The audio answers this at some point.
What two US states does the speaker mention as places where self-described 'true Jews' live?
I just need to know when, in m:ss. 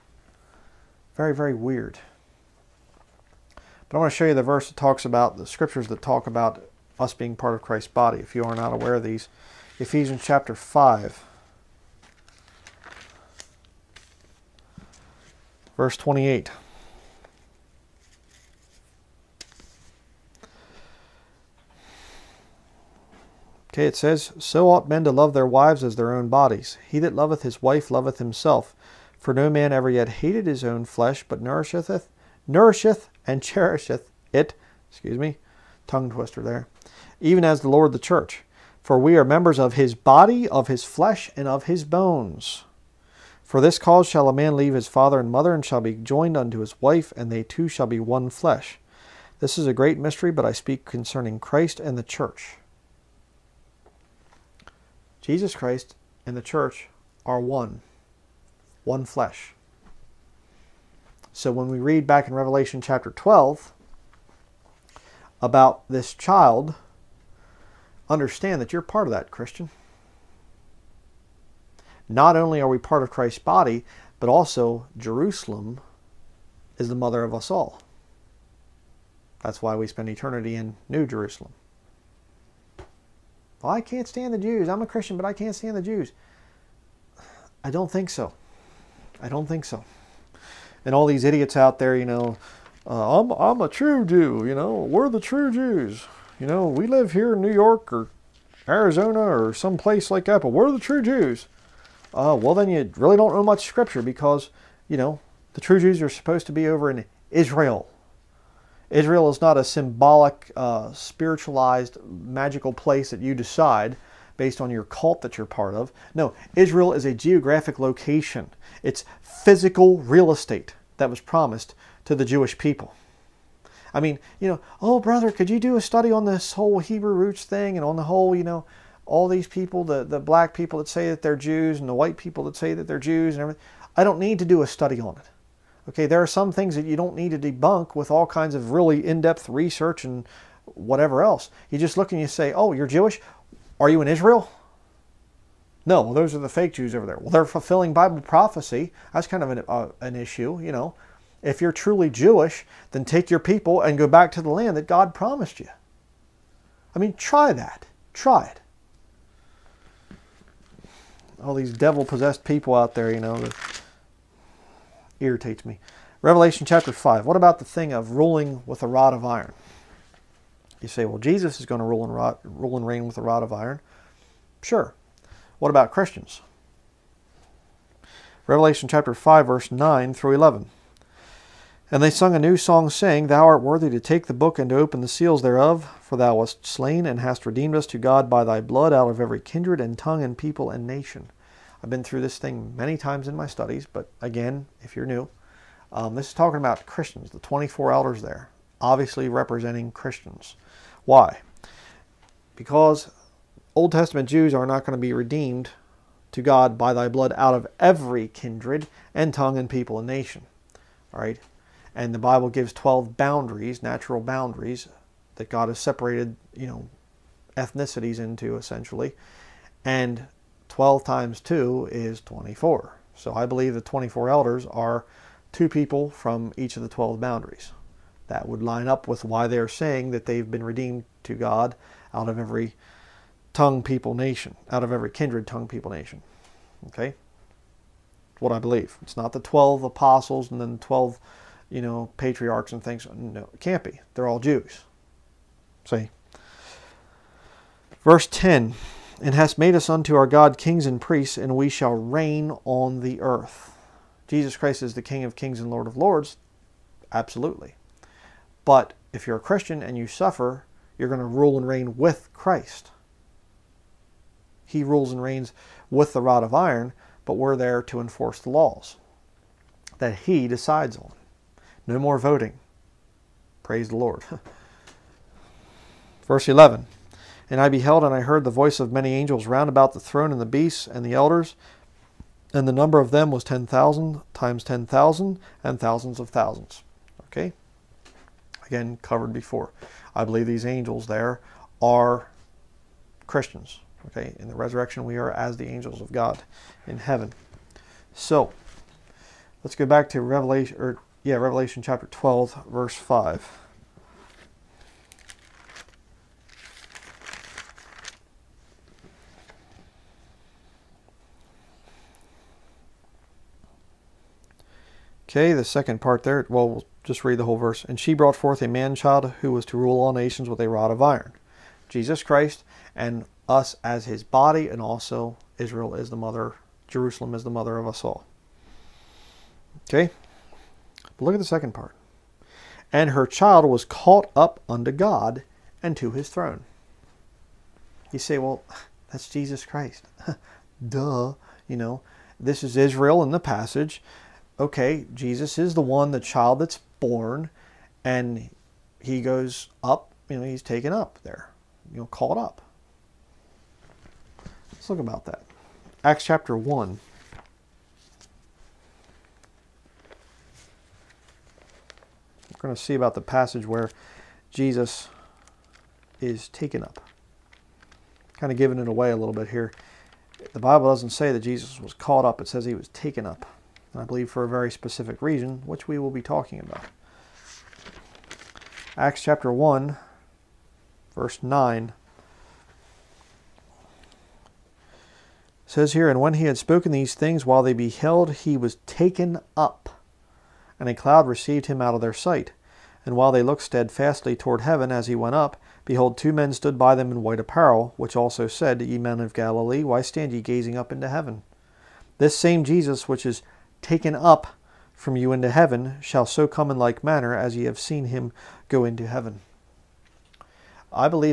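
1:37.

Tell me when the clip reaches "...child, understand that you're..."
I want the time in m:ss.
1:06.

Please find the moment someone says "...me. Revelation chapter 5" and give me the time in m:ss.
2:45.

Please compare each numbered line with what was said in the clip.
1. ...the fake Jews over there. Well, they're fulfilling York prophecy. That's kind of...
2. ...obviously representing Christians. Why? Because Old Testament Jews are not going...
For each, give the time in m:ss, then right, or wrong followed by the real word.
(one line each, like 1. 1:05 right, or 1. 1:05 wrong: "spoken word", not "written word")
1. 2:26 wrong: "Bible", not "York"
2. 3:18 right.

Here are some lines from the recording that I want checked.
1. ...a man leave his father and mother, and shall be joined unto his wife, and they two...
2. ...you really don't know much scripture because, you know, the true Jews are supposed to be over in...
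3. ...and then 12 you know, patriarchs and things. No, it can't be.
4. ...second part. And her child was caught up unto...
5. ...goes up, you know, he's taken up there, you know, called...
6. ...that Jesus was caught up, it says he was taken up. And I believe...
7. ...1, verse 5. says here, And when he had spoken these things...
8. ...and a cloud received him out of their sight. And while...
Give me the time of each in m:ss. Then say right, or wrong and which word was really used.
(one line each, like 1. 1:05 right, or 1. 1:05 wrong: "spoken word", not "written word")
1. 0:44 right
2. 1:42 right
3. 4:00 right
4. 5:31 right
5. 5:49 right
6. 6:11 right
7. 6:19 wrong: "9", not "5"
8. 6:30 right.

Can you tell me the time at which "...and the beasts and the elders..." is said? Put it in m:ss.
4:40.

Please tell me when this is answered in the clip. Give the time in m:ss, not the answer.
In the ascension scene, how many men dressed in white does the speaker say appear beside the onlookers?
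6:36.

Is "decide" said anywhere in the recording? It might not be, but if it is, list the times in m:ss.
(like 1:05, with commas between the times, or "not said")
1:53, 4:30.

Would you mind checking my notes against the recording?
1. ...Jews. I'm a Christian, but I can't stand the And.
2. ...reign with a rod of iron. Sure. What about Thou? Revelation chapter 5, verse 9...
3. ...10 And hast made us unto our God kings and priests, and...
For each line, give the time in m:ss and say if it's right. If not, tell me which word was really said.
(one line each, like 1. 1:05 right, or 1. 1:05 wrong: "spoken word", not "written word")
1. 1:24 wrong: "Jews", not "And"
2. 2:52 wrong: "Christians", not "Thou"
3. 4:08 right.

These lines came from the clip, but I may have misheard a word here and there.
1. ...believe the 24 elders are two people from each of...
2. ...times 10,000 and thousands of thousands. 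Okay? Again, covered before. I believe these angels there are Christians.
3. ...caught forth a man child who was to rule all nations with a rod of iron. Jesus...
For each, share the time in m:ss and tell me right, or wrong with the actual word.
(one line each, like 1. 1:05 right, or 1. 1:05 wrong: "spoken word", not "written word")
1. 3:43 right
2. 4:44 right
3. 5:18 wrong: "brought", not "caught".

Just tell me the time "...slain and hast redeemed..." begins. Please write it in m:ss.
3:06.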